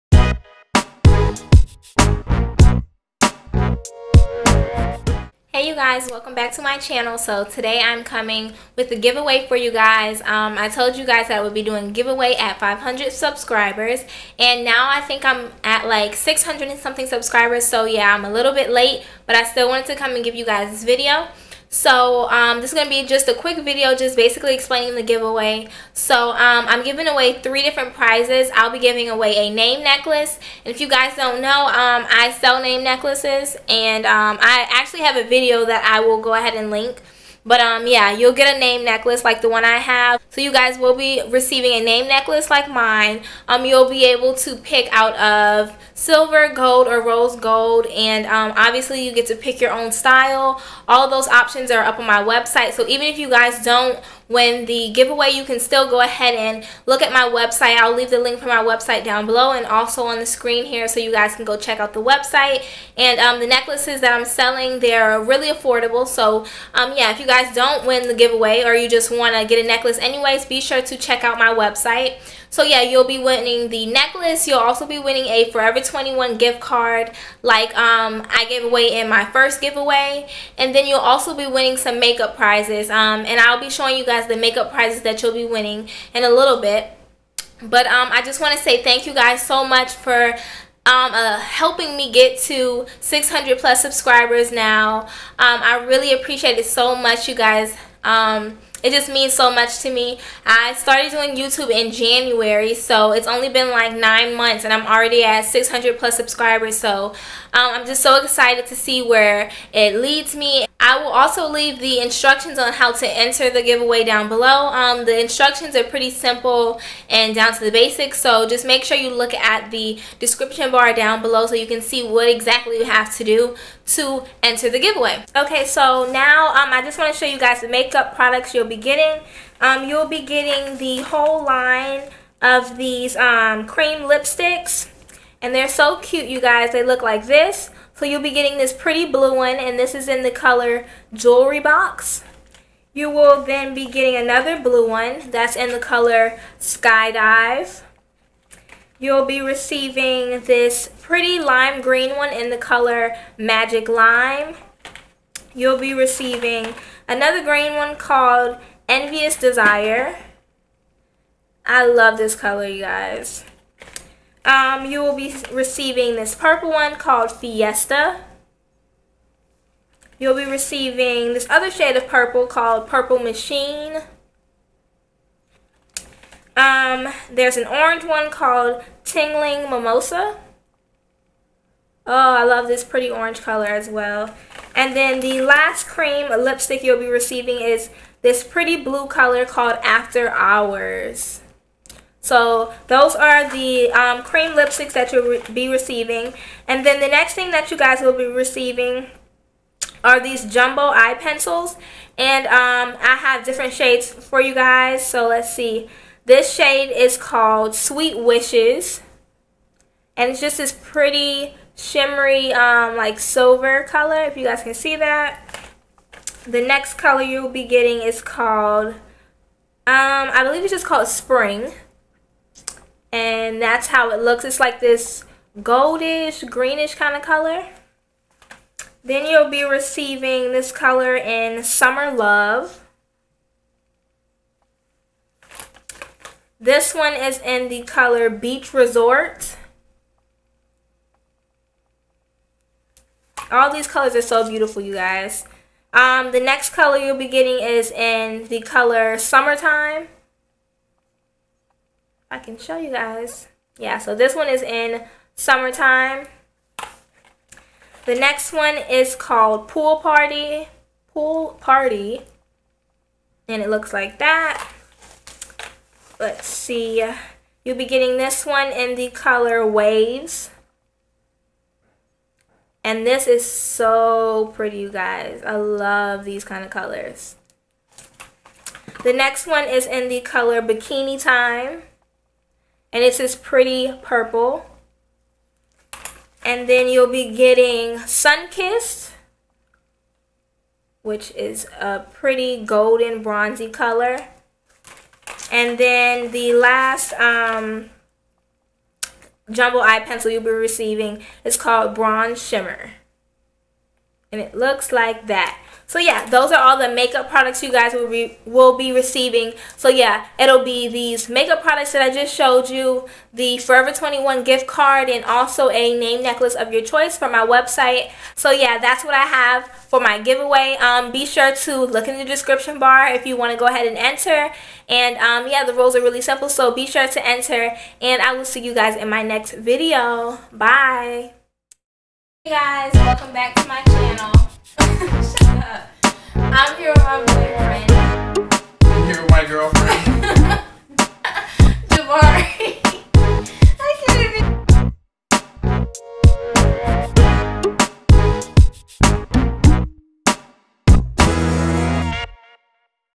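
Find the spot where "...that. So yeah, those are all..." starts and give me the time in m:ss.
5:05.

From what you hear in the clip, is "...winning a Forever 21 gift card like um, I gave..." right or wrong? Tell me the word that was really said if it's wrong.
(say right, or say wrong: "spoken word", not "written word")
right.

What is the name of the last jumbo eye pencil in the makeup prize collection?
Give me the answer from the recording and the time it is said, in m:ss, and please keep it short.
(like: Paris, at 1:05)
Bronze Shimmer, at 5:01.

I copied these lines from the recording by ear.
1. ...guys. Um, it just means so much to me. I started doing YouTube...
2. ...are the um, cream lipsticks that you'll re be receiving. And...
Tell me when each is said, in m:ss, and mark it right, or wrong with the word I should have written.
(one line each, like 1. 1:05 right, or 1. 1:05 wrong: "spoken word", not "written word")
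1. 1:37 right
2. 3:13 right.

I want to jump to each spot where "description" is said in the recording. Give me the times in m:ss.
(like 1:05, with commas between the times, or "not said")
2:00, 5:22.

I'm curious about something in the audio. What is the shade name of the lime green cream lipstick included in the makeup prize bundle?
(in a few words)
Magic Lime.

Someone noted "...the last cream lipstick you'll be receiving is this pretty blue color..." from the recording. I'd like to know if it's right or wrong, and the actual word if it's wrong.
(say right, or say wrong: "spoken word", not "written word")
right.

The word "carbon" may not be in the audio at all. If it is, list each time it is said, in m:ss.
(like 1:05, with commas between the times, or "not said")
not said.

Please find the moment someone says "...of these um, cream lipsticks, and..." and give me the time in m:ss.
2:12.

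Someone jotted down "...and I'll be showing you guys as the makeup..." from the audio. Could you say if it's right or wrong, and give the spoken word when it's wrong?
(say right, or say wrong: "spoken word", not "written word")
right.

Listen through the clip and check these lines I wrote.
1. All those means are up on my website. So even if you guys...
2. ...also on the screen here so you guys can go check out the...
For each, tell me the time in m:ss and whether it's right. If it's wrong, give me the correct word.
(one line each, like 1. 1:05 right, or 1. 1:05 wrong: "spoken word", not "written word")
1. 0:50 wrong: "options", not "means"
2. 0:59 right.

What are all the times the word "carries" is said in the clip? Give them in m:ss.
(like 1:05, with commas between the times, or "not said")
not said.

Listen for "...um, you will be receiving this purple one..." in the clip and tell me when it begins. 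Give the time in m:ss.
2:44.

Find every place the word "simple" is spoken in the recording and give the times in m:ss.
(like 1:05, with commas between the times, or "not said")
1:56, 5:26.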